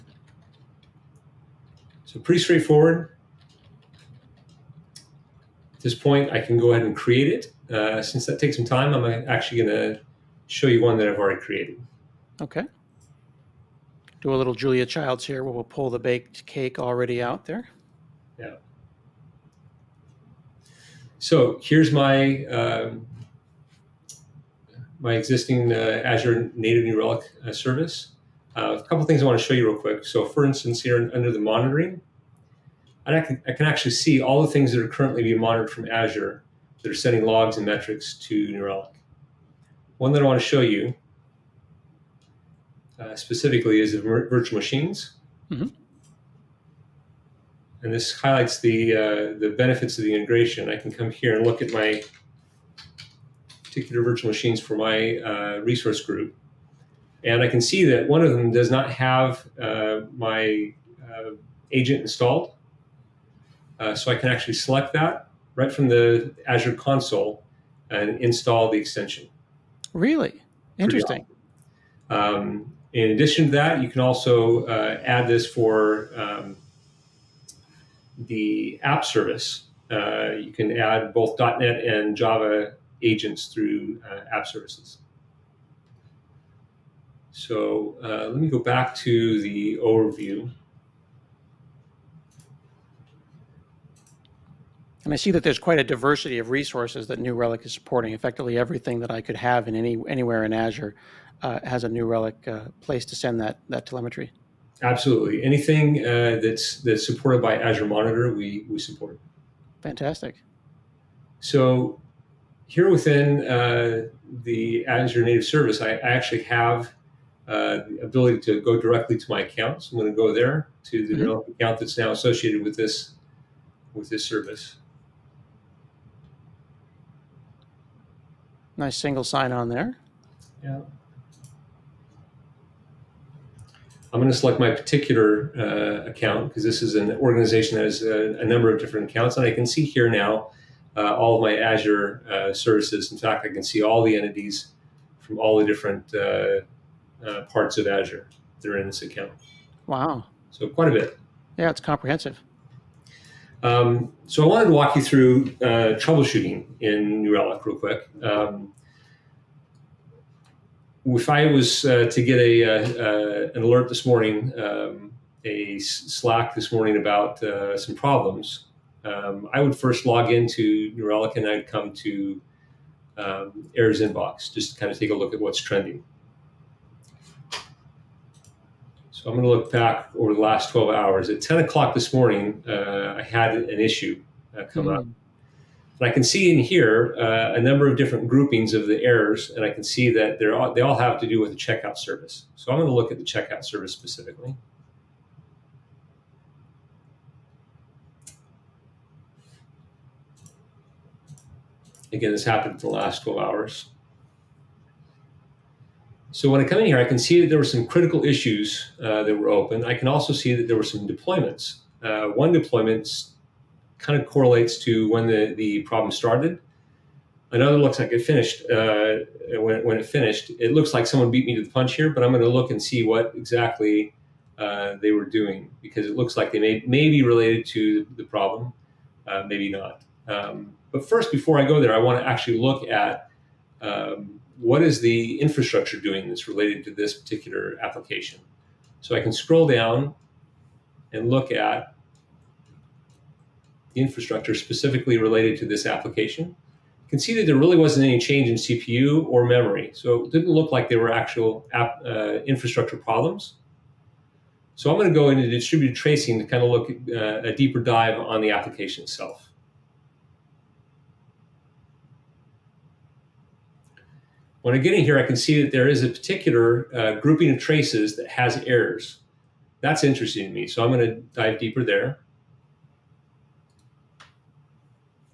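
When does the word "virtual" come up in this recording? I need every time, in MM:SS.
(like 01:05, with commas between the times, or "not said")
00:43, 00:54.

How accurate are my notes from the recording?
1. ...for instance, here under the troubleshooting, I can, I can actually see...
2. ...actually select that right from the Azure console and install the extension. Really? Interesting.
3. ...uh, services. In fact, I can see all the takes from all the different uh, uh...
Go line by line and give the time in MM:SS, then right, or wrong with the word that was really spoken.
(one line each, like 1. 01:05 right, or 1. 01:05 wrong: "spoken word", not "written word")
1. 00:30 wrong: "monitoring", not "troubleshooting"
2. 01:04 right
3. 02:22 wrong: "entities", not "takes".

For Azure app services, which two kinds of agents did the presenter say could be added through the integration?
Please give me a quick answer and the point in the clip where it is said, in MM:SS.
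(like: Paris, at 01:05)
.NET and Java, at 01:21.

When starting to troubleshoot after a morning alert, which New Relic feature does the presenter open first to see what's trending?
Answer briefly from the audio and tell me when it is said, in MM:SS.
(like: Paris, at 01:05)
Errors inbox, at 02:53.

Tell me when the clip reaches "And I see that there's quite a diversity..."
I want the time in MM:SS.
01:35.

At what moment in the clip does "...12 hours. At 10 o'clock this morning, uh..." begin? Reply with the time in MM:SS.
03:00.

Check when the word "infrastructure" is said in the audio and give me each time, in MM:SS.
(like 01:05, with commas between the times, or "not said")
03:55, 04:03, 04:12.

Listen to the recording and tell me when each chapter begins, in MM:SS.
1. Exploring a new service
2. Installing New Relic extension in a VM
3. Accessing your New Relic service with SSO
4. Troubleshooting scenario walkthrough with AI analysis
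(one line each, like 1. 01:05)
1. 00:13
2. 00:56
3. 01:51
4. 02:33.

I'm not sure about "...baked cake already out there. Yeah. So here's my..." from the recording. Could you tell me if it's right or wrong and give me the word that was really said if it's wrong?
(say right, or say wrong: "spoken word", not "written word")
right.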